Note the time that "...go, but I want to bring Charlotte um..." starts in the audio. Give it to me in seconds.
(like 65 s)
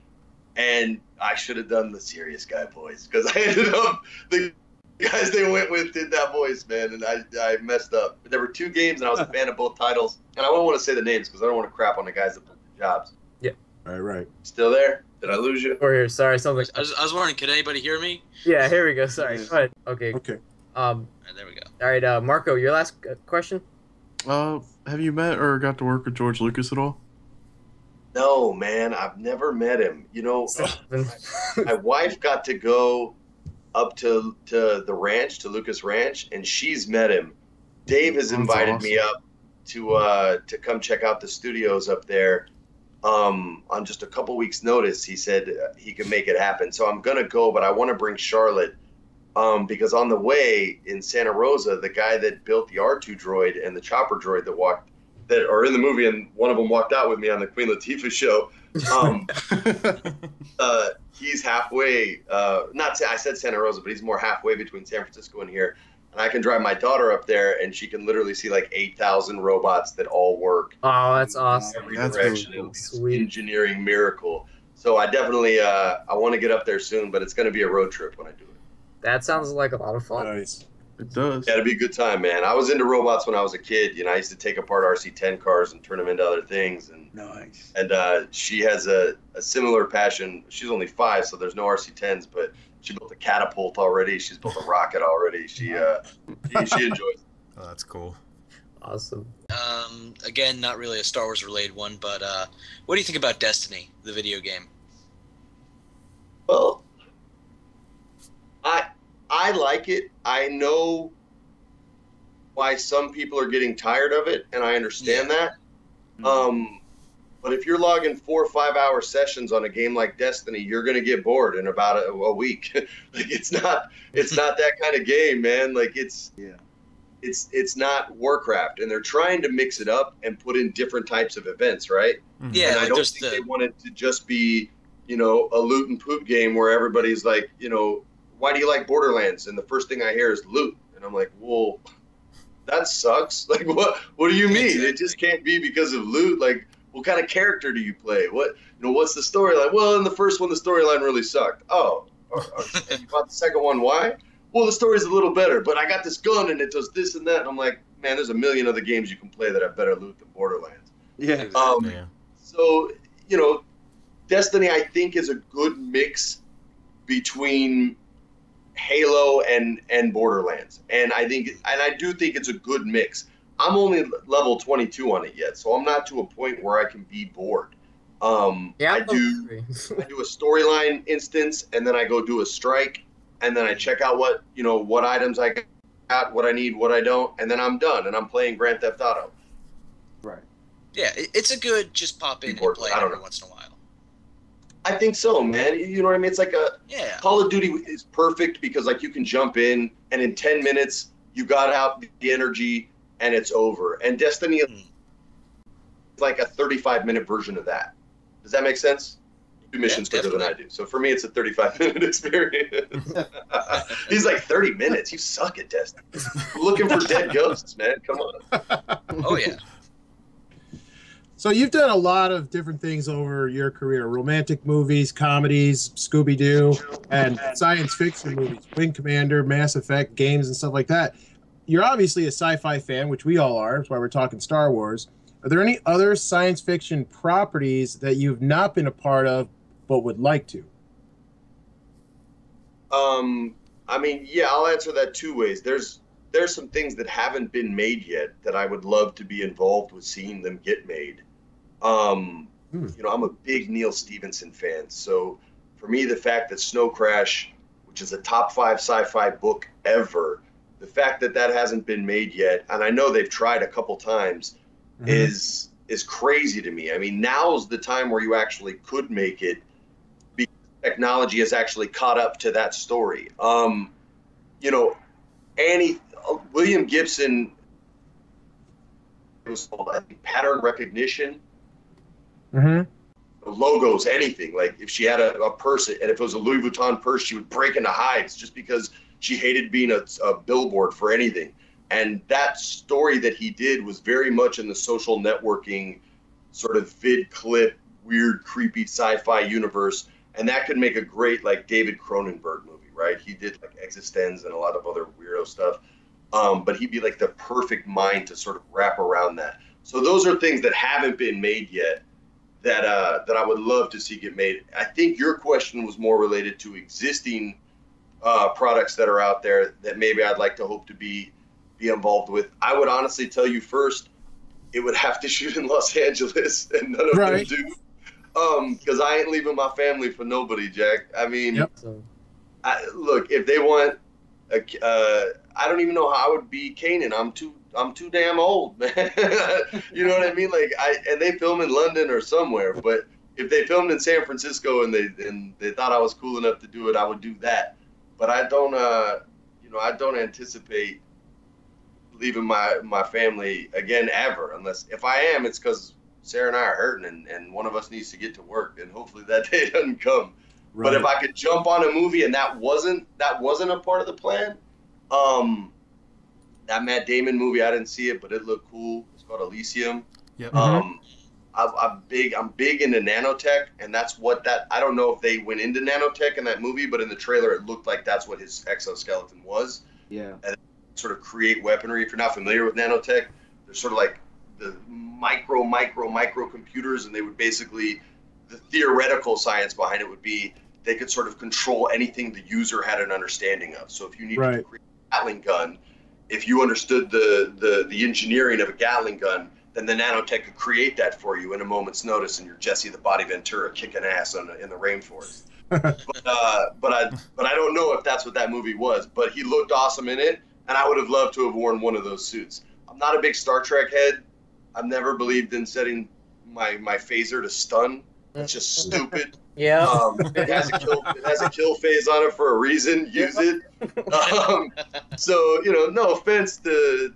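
47 s.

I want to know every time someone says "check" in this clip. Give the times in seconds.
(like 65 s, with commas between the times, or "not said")
40 s, 183 s.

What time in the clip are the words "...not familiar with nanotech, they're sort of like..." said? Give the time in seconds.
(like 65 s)
382 s.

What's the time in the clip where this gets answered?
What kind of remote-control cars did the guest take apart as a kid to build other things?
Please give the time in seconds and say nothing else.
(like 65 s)
84 s.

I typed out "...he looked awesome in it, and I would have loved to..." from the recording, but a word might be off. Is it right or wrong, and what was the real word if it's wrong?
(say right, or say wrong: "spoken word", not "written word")
right.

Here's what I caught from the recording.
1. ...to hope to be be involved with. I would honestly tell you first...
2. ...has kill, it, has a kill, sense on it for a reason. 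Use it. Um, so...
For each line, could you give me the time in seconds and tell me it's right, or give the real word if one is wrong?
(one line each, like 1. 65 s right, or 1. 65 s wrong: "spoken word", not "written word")
1. 320 s right
2. 420 s wrong: "phase", not "sense".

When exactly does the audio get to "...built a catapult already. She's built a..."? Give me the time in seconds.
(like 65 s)
92 s.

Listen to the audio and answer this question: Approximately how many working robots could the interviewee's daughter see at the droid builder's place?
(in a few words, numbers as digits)
8000.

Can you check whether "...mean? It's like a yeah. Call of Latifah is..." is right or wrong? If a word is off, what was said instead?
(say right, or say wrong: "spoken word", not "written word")
wrong: "Duty", not "Latifah".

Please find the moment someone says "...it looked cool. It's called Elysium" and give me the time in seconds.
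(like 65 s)
368 s.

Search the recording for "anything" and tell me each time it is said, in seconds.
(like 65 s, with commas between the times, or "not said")
284 s, 291 s, 391 s.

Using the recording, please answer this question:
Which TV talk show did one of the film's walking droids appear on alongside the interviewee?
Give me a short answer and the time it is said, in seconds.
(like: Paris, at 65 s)
The Queen Latifah Show, at 57 s.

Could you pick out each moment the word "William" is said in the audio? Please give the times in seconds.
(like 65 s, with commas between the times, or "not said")
276 s.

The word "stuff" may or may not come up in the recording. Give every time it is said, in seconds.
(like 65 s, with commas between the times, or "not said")
230 s, 305 s.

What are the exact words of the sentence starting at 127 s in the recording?
It's it's not Warcraft, and they're trying to mix it up and put in different types of events, right?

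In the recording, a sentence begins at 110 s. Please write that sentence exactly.
I know why some people are getting tired of it, and I understand yeah.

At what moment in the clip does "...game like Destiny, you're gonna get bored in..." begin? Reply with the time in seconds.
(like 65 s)
119 s.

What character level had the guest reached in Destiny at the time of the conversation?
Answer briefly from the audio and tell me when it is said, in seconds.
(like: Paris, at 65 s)
22, at 174 s.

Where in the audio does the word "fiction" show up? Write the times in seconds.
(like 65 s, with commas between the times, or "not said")
227 s, 236 s.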